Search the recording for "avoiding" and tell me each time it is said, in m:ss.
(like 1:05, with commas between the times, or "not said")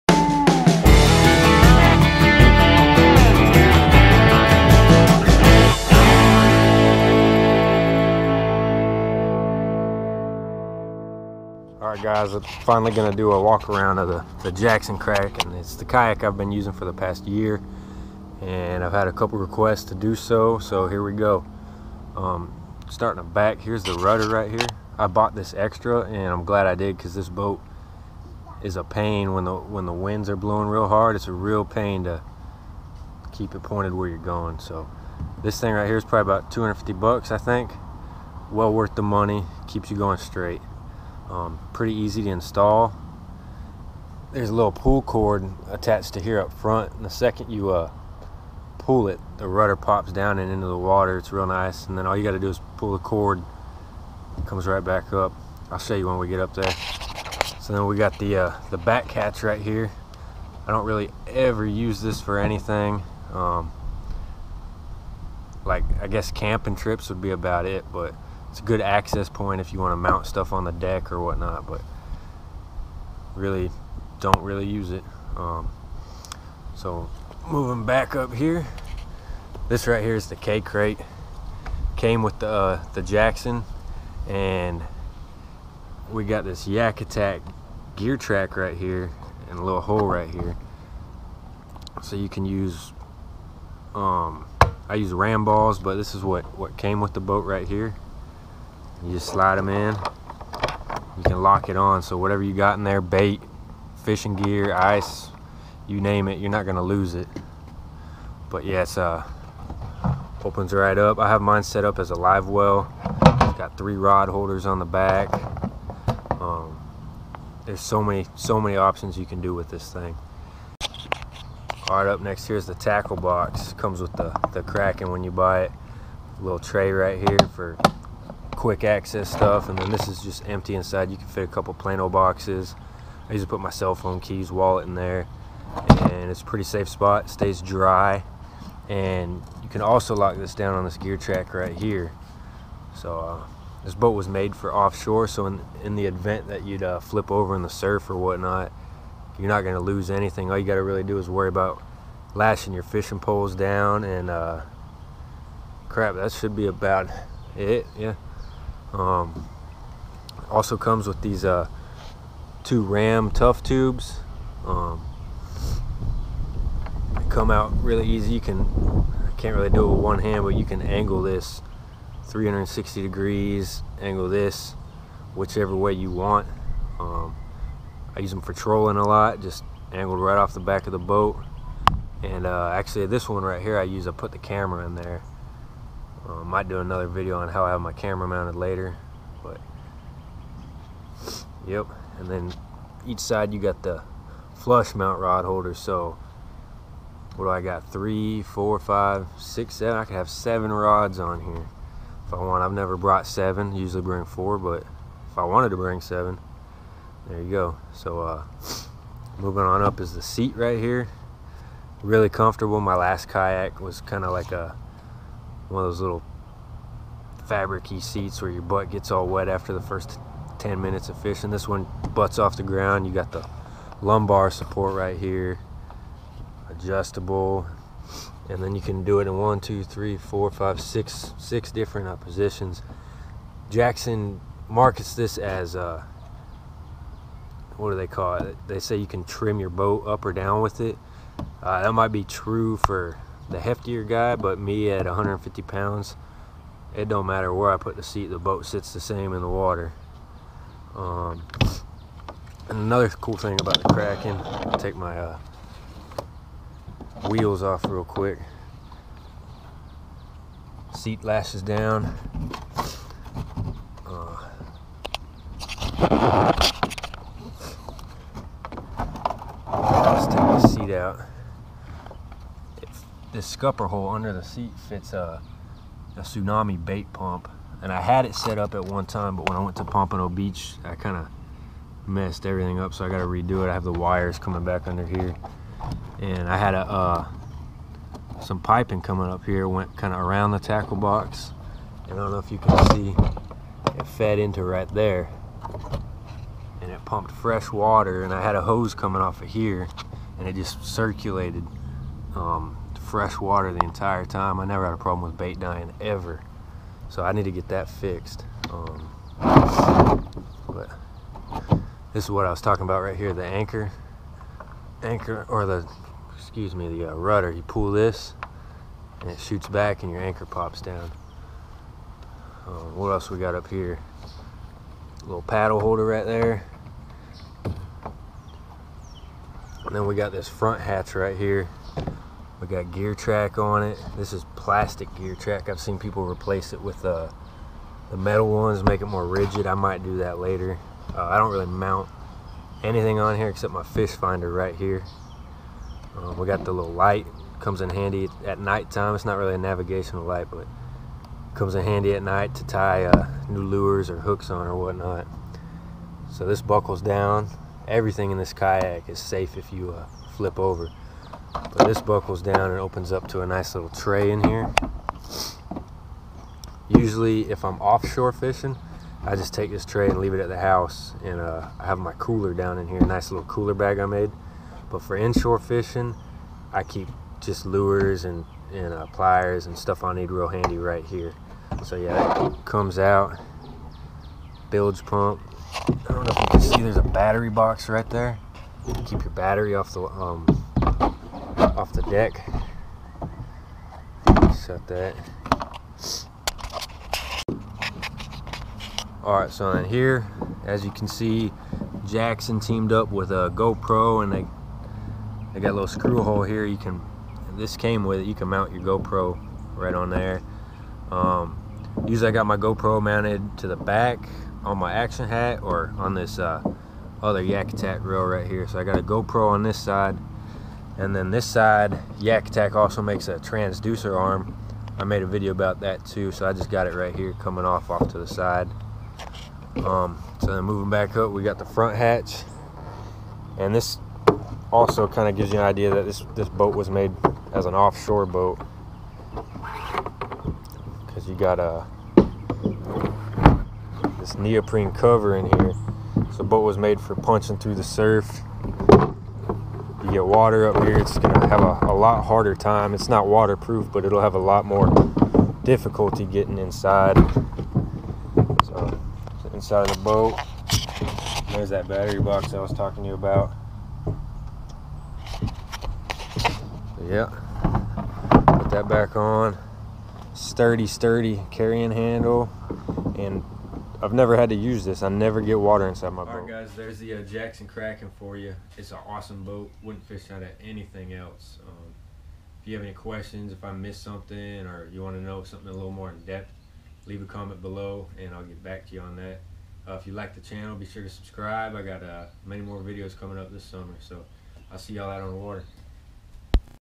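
not said.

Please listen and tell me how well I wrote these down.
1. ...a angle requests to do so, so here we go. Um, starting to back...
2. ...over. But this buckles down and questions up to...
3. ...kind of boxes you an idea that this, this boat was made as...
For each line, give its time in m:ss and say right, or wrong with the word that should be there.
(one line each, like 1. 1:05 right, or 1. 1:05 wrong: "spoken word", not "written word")
1. 0:19 wrong: "couple", not "angle"
2. 6:00 wrong: "opens", not "questions"
3. 7:15 wrong: "gives", not "boxes".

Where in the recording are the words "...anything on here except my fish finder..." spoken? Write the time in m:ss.
5:42.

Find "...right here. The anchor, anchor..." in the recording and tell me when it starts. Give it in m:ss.
5:13.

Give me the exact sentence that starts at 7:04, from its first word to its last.
I made a video about that too, so I just got it right here coming off off to the side.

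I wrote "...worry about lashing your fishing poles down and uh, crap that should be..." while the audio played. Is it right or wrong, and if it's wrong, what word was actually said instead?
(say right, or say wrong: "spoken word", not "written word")
right.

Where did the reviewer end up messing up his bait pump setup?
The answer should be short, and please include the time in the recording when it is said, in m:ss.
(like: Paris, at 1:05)
Pompano Beach, at 4:39.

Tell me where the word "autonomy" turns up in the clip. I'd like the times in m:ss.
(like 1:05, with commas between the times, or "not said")
not said.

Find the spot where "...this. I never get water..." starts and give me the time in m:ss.
7:54.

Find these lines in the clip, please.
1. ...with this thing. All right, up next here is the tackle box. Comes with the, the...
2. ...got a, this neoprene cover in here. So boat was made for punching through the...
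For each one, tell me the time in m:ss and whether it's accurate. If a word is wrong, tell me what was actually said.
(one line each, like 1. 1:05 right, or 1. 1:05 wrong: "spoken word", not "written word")
1. 1:59 right
2. 7:21 right.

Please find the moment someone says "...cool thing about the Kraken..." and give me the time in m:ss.
4:13.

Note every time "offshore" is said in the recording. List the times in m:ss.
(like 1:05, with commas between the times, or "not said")
2:24, 6:07, 7:17.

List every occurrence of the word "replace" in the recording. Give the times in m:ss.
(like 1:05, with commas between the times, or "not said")
5:36.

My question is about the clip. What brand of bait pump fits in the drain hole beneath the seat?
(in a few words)
Tsunami.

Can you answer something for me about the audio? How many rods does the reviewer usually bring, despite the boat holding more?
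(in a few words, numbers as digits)
4.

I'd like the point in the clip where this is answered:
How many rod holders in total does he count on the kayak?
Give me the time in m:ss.
3:19.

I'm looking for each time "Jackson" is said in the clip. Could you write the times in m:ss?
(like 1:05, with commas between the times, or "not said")
0:14, 1:23, 3:53, 6:42, 7:57.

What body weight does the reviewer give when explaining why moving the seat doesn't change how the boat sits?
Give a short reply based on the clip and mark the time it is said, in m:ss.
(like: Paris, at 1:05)
150 pounds, at 4:05.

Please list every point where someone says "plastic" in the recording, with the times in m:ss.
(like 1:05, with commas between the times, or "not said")
5:34.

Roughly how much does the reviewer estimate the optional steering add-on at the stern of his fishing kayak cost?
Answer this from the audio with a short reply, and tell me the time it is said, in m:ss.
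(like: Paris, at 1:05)
$250, at 0:36.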